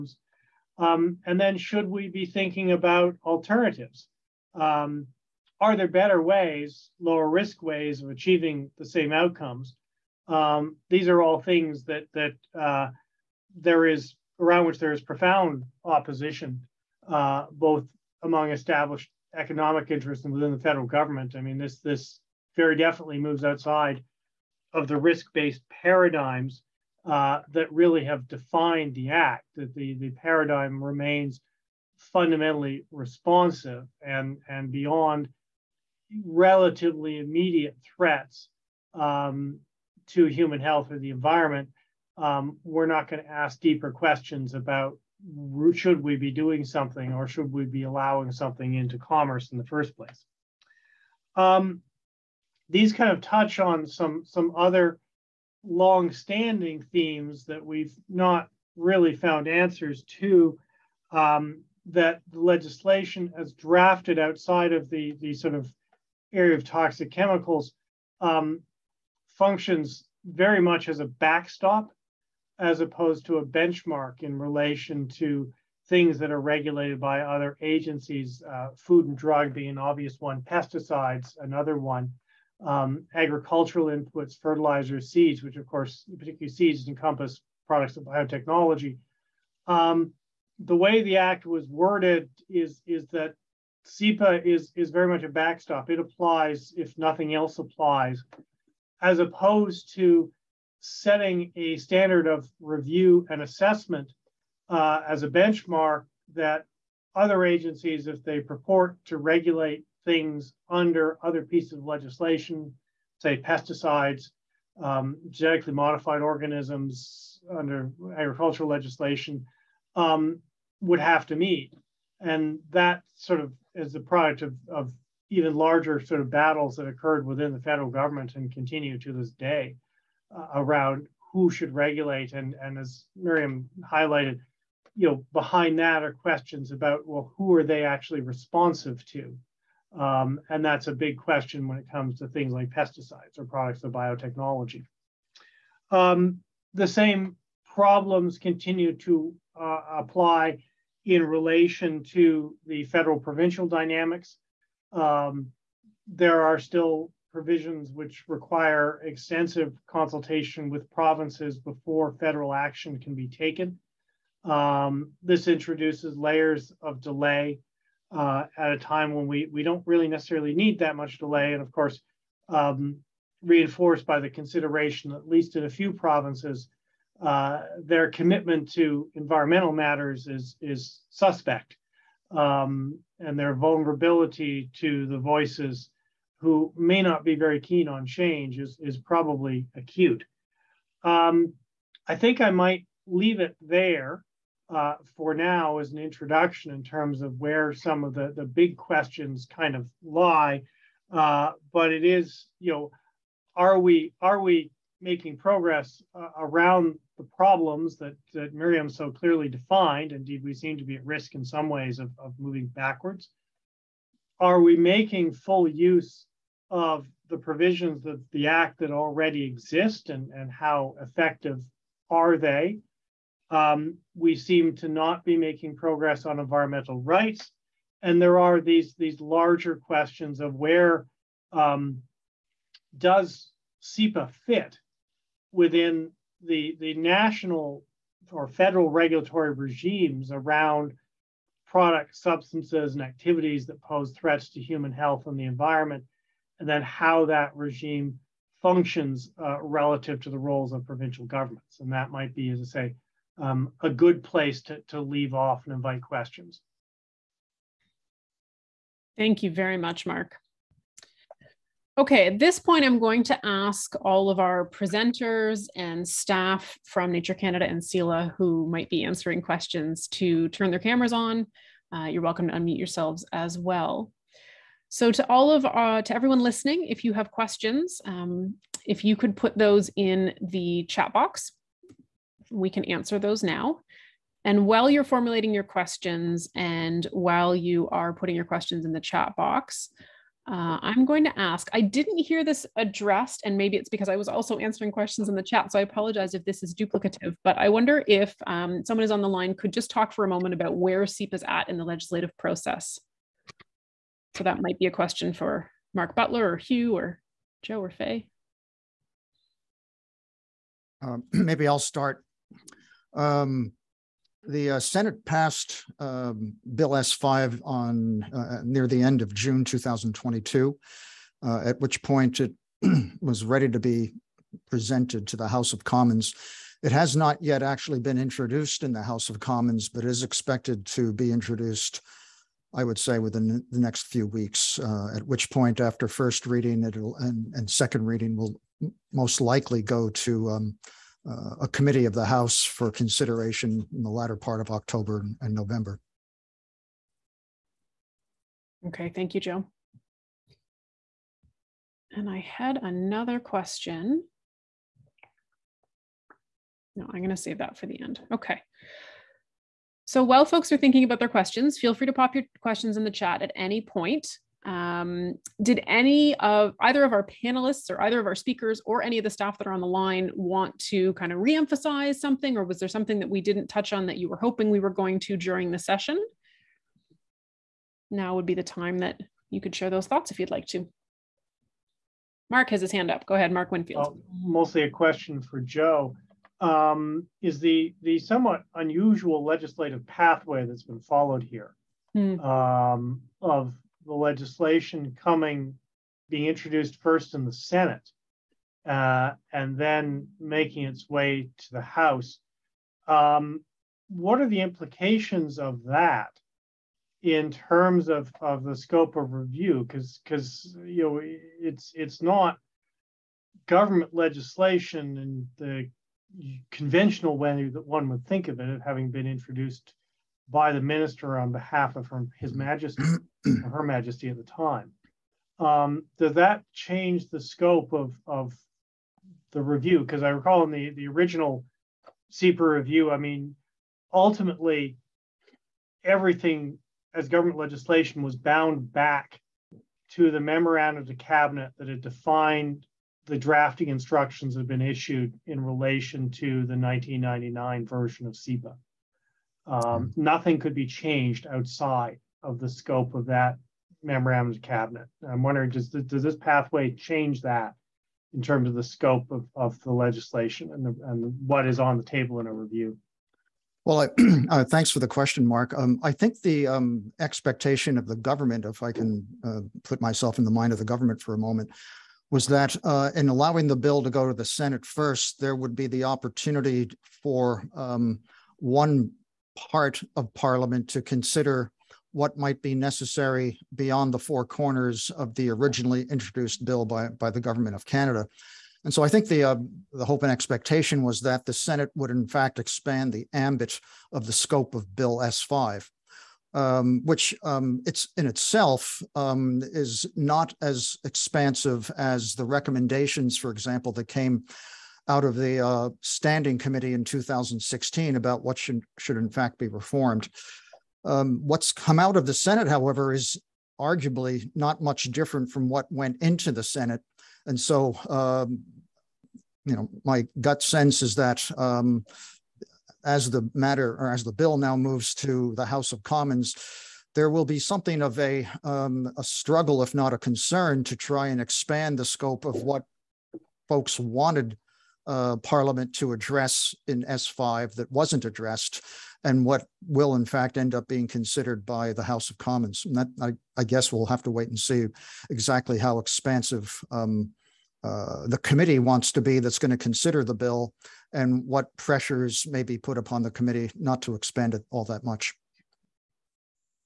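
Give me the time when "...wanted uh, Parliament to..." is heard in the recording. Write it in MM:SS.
08:53.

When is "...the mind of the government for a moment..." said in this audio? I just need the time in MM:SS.
07:50.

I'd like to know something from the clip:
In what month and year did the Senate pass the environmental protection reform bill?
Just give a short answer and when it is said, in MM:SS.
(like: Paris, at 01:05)
June 2022, at 05:19.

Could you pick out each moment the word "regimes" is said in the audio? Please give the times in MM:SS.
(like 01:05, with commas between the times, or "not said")
03:59, 04:07.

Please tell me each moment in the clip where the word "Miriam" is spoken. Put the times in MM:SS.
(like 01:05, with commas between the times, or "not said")
02:13, 03:28.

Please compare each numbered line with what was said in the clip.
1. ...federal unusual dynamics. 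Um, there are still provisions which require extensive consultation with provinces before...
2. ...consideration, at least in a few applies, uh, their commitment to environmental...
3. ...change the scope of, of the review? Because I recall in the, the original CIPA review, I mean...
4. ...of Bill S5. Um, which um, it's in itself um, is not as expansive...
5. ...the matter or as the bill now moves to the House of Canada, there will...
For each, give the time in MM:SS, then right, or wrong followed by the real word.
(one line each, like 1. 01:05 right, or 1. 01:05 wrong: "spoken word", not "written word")
1. 02:32 wrong: "provincial", not "unusual"
2. 02:54 wrong: "provinces", not "applies"
3. 07:06 right
4. 08:14 right
5. 08:43 wrong: "Commons", not "Canada".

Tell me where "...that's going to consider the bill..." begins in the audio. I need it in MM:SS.
09:09.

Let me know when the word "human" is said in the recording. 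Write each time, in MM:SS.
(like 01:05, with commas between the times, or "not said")
00:40, 04:04.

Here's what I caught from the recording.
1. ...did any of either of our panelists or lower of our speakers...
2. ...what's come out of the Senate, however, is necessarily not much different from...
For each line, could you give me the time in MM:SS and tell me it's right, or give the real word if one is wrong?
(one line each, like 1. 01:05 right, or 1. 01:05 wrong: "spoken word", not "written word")
1. 06:05 wrong: "either", not "lower"
2. 08:31 wrong: "arguably", not "necessarily".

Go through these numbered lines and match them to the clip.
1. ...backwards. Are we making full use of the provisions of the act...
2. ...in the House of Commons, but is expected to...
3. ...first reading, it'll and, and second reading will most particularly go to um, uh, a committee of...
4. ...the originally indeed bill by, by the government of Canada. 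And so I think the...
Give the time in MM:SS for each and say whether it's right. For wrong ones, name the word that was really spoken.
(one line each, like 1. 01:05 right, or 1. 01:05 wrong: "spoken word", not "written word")
1. 03:32 right
2. 05:28 right
3. 05:36 wrong: "likely", not "particularly"
4. 08:05 wrong: "introduced", not "indeed".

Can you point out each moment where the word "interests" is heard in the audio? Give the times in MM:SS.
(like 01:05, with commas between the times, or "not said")
00:19.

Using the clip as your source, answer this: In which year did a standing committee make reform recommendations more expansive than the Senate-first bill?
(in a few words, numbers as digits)
2016.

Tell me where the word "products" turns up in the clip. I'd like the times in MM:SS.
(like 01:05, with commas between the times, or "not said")
01:27, 02:03, 02:23, 04:01.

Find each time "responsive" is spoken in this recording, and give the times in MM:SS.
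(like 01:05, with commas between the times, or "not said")
00:32, 02:18.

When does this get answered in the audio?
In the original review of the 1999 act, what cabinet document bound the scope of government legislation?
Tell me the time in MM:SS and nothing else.
07:20.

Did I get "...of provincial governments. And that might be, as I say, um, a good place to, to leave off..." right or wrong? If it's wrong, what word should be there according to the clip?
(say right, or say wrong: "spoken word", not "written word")
right.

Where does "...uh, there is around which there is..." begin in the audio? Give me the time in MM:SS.
00:12.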